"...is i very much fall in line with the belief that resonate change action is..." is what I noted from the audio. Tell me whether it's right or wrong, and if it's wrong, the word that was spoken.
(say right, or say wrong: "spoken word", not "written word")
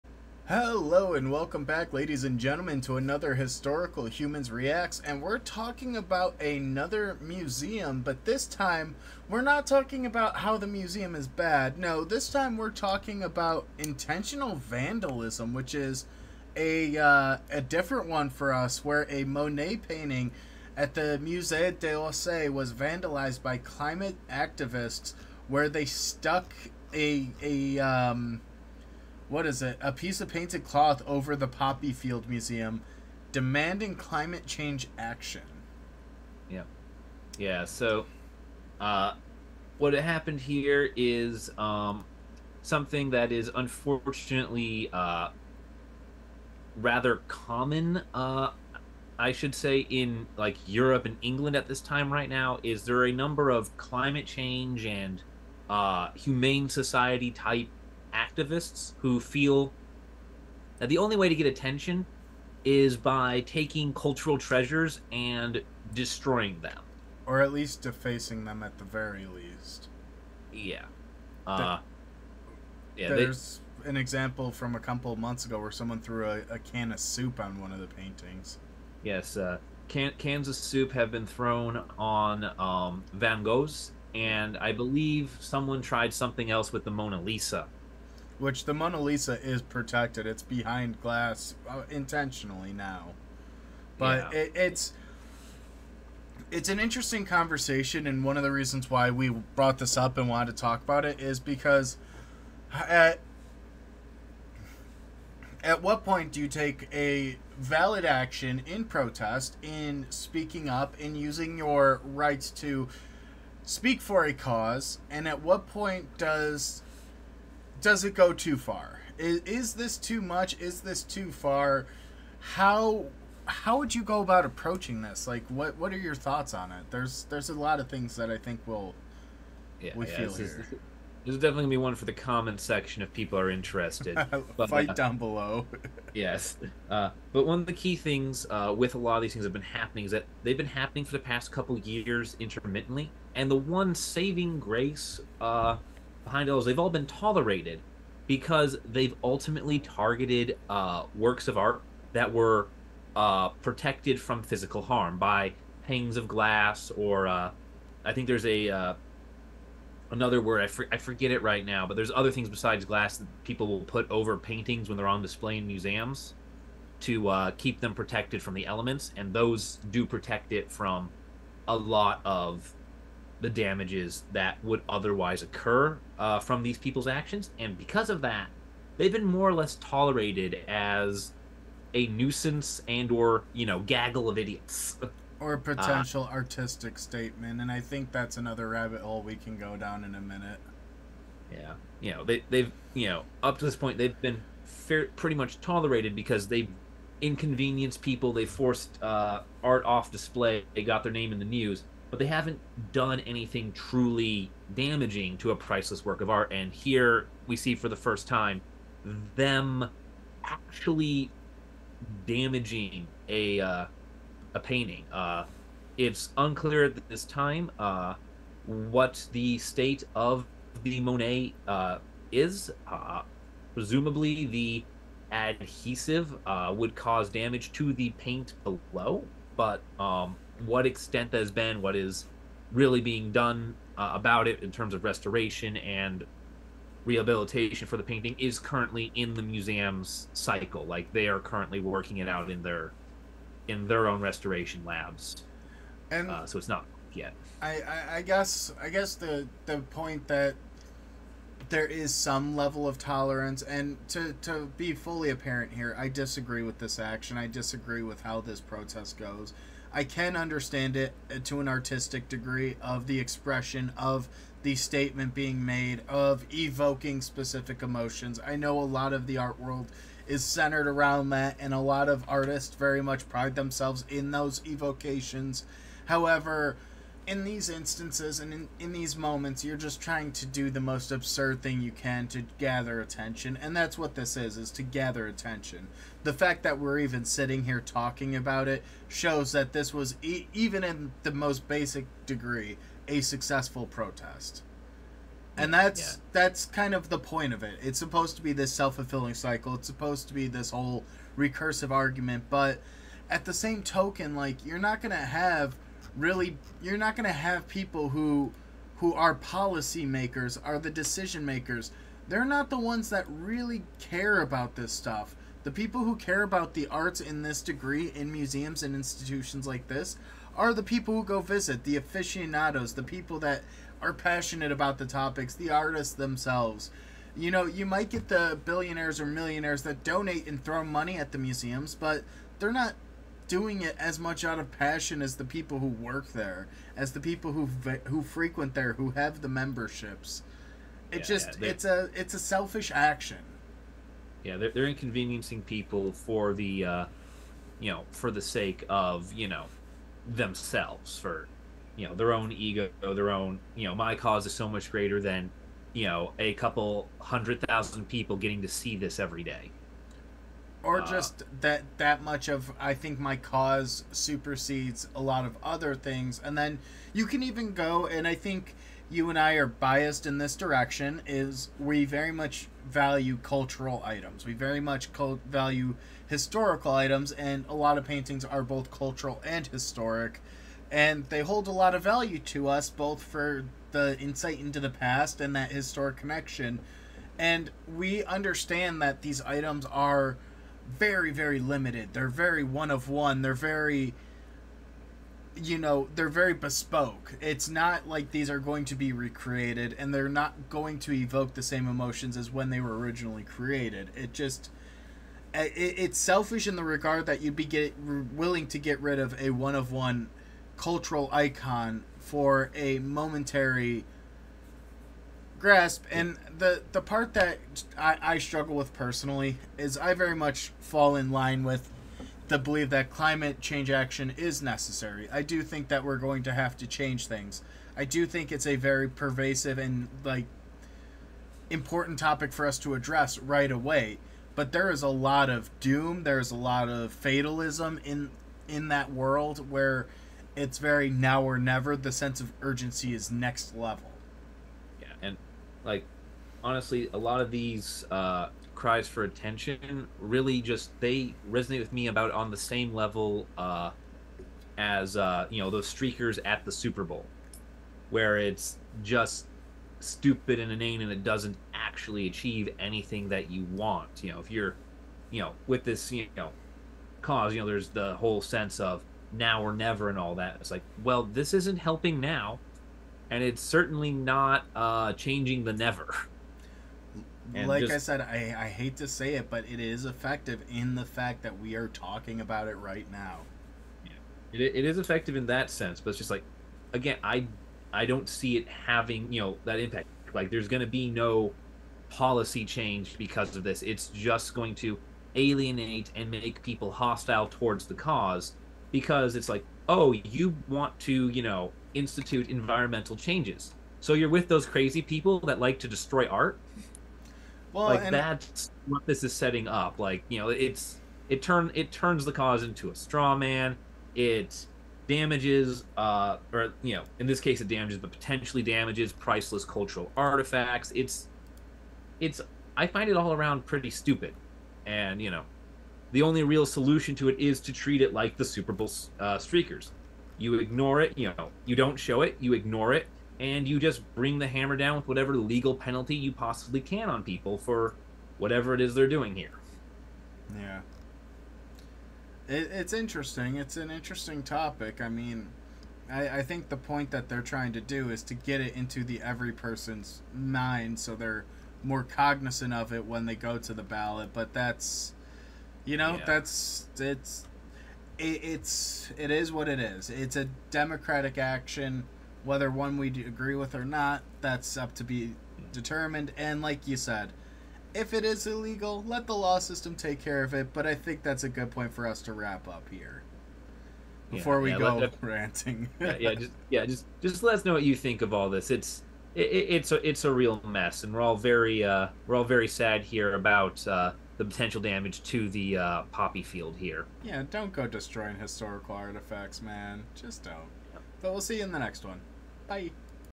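wrong: "climate", not "resonate".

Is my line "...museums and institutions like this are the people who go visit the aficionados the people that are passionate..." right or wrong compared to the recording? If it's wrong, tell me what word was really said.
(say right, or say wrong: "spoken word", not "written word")
right.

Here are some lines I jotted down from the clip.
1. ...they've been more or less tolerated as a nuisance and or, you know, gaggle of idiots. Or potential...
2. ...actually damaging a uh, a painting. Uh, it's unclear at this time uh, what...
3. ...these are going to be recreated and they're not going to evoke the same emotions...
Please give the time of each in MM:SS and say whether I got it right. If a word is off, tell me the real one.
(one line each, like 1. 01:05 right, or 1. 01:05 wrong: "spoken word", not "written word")
1. 02:58 right
2. 03:30 right
3. 06:38 right.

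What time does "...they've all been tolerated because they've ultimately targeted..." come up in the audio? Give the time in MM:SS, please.
02:26.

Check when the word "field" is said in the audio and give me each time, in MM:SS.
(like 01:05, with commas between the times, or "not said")
00:31, 09:46.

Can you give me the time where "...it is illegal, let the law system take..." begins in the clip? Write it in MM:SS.
09:28.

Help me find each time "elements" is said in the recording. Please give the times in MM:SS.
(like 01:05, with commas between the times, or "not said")
02:48.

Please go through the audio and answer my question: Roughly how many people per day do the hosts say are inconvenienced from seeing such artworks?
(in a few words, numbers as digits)
a couple hundred thousand.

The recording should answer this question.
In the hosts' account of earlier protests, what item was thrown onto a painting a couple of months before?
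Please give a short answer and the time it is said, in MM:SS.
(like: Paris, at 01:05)
a can of soup, at 01:16.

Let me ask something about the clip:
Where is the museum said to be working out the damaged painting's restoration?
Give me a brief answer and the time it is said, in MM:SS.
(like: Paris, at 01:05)
restoration labs, at 04:04.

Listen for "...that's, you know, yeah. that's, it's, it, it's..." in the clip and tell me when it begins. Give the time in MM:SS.
09:14.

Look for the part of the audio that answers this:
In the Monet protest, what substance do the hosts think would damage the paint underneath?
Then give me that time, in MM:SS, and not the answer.
03:45.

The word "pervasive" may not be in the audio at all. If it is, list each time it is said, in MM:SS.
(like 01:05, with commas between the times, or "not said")
07:09.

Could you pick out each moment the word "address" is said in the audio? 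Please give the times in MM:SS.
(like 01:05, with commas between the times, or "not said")
07:12.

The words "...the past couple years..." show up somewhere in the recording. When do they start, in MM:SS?
02:21.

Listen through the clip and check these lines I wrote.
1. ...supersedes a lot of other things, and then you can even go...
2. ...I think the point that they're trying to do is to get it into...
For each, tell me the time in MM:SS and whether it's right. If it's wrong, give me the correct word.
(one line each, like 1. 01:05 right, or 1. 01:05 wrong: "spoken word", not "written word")
1. 06:04 right
2. 09:06 right.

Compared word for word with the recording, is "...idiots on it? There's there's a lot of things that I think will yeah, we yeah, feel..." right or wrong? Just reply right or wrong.
wrong.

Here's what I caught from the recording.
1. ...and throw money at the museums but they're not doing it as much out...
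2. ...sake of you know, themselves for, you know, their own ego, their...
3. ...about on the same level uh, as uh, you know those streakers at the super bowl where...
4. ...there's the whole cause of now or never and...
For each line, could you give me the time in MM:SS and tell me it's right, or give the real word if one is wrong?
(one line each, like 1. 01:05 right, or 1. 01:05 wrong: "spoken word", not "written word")
1. 05:30 right
2. 05:48 right
3. 07:32 right
4. 07:47 wrong: "sense", not "cause".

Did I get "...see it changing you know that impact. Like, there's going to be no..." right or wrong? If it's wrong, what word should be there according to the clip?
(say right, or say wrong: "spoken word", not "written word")
wrong: "having", not "changing".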